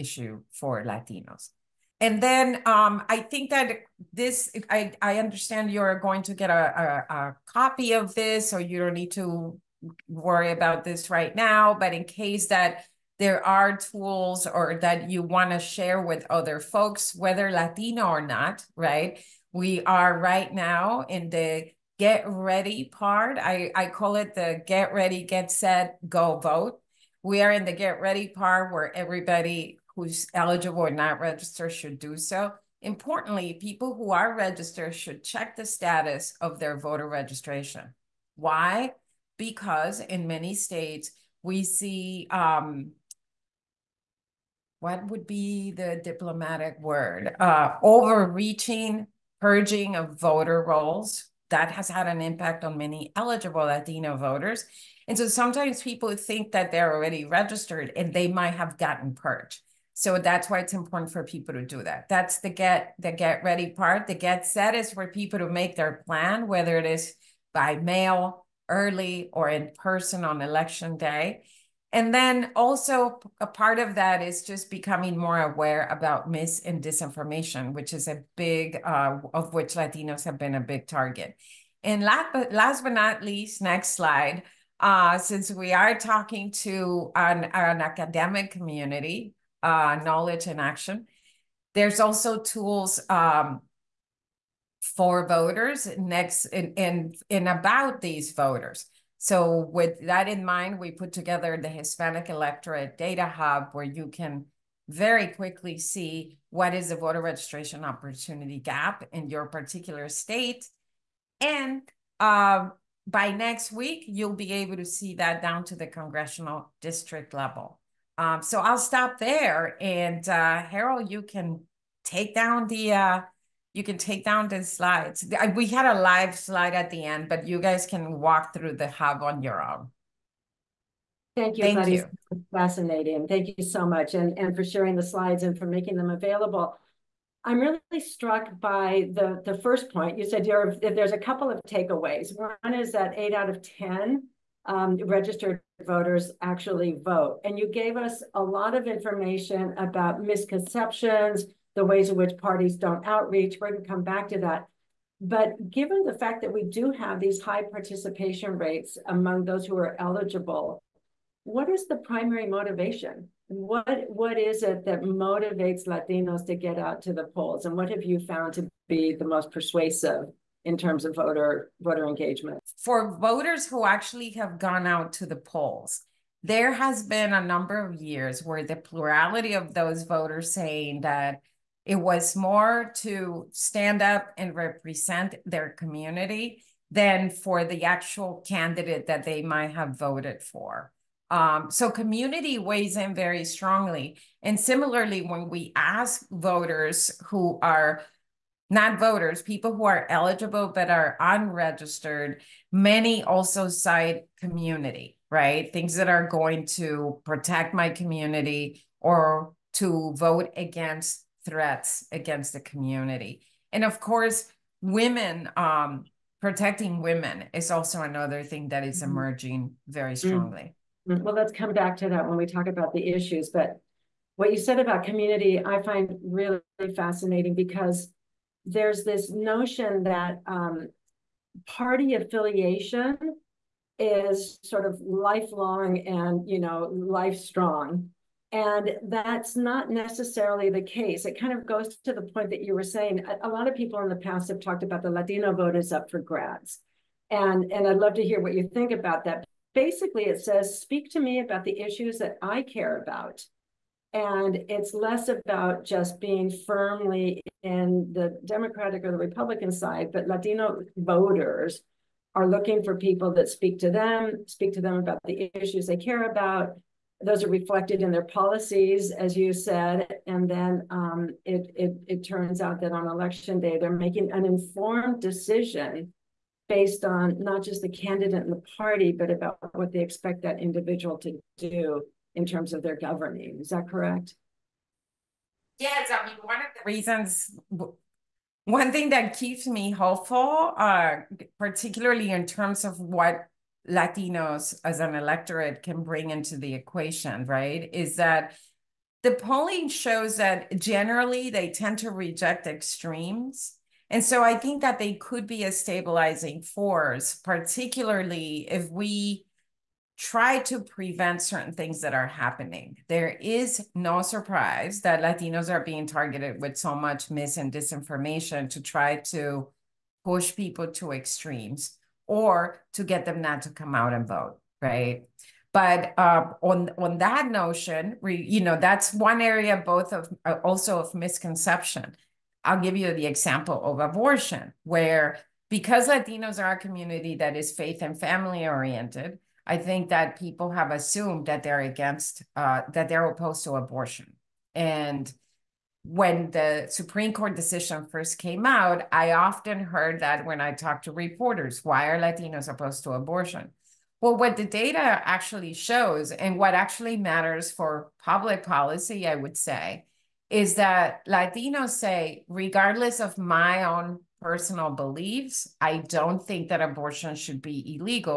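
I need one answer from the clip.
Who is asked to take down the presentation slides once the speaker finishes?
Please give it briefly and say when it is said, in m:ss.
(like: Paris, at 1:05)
Harold, at 2:00.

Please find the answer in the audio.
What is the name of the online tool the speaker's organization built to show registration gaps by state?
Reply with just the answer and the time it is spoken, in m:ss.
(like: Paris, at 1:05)
Hispanic Electorate Data Hub, at 1:41.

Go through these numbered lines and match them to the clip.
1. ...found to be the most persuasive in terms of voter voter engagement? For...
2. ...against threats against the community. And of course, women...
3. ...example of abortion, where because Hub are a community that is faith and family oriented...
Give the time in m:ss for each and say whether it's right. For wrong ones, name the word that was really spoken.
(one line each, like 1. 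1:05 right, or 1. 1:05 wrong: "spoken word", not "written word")
1. 2:48 right
2. 3:30 right
3. 5:33 wrong: "Latinos", not "Hub".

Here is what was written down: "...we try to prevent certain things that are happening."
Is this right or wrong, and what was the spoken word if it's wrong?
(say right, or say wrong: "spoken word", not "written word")
right.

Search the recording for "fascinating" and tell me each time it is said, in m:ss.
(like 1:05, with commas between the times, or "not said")
2:12, 3:46.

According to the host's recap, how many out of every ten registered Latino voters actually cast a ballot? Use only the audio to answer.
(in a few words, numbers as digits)
8.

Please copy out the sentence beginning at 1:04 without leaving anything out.
The get set is for people to make their plan, whether it is by mail, early, or in person on election day.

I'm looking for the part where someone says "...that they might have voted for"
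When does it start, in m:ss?
3:09.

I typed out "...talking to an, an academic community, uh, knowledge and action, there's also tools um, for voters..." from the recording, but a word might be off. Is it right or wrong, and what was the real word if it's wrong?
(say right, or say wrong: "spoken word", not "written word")
right.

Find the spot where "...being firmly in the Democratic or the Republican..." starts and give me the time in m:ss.
4:16.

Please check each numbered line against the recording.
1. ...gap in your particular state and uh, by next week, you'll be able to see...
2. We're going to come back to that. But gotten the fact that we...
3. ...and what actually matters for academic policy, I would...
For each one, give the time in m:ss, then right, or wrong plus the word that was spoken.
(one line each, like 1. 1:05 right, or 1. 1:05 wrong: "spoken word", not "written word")
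1. 1:48 right
2. 2:33 wrong: "given", not "gotten"
3. 5:56 wrong: "public", not "academic".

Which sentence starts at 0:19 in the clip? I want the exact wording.
We are right now in the get ready part.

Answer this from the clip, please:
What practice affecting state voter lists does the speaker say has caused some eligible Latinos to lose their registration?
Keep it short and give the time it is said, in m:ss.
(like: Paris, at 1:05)
Purging of voter rolls, at 0:49.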